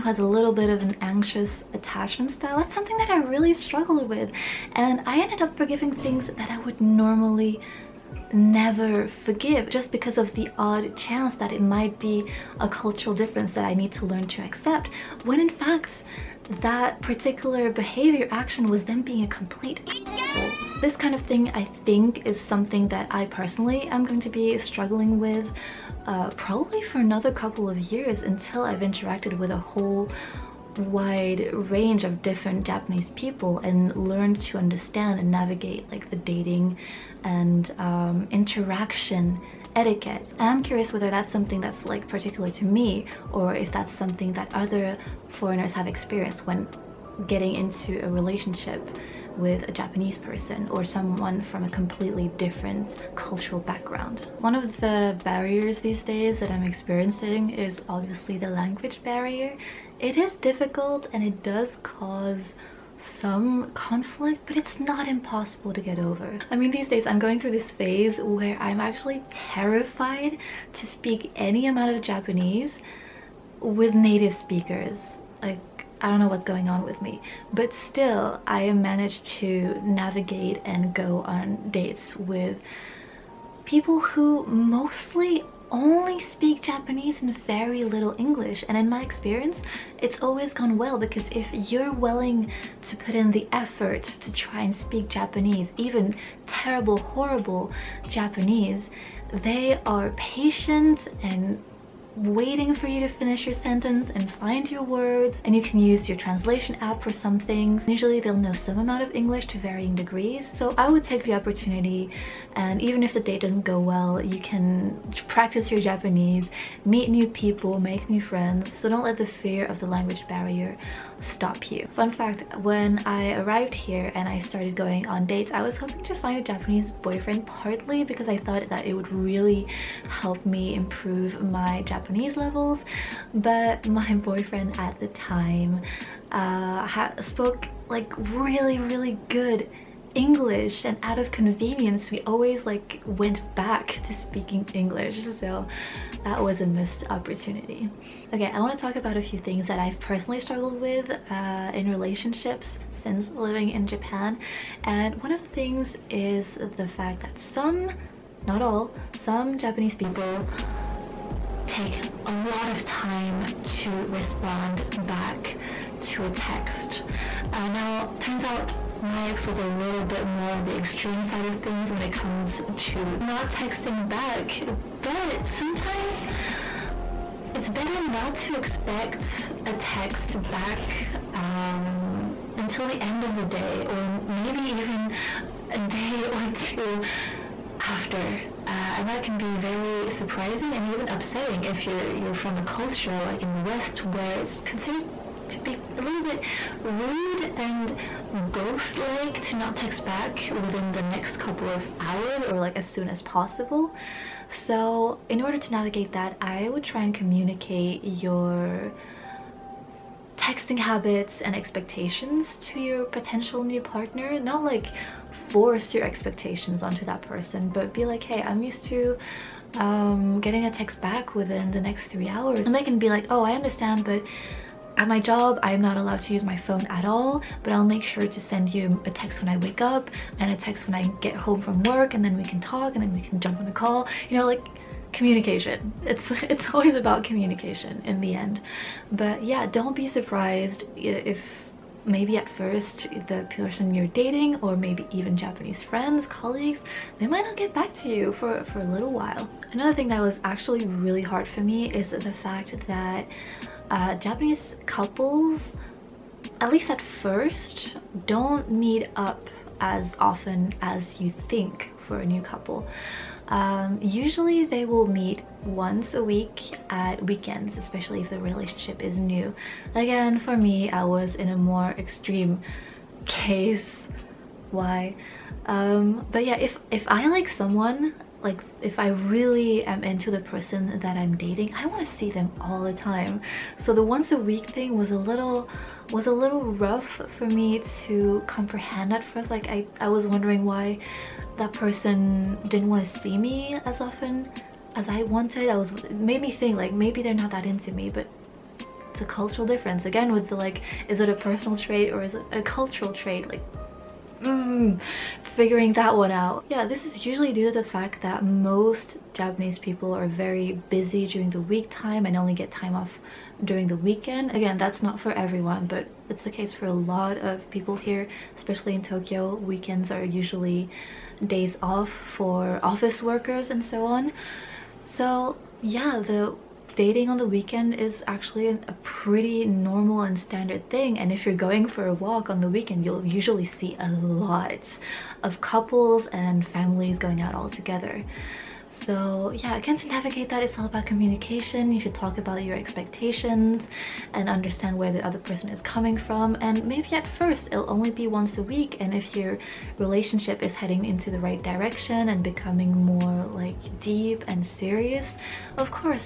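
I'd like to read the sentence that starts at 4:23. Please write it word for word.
Um, usually they will meet once a week at weekends, especially if the relationship is new.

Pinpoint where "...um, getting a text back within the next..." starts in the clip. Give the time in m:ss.
3:39.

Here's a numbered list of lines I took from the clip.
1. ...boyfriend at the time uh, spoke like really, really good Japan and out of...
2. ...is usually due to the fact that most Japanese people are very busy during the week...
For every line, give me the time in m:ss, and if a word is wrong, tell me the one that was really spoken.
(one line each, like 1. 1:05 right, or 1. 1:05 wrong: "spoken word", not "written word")
1. 2:14 wrong: "English", not "Japan"
2. 5:07 right.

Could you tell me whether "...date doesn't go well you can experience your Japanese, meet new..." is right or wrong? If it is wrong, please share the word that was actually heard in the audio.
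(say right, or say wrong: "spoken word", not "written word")
wrong: "practice", not "experience".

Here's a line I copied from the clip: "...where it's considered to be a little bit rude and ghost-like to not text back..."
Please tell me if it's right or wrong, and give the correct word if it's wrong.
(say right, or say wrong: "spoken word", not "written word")
right.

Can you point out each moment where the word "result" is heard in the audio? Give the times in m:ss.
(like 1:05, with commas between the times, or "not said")
not said.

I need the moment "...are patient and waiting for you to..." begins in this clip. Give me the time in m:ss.
1:39.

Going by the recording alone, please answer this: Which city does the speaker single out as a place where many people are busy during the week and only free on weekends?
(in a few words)
Tokyo.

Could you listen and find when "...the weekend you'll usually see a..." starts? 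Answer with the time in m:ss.
5:32.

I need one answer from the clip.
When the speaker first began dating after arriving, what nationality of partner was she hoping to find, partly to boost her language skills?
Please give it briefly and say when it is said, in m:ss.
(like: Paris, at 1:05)
Japanese boyfriend, at 2:06.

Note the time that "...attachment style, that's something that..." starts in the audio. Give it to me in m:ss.
0:01.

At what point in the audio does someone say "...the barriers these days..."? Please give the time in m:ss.
0:54.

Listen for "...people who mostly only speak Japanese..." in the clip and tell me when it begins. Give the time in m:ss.
1:23.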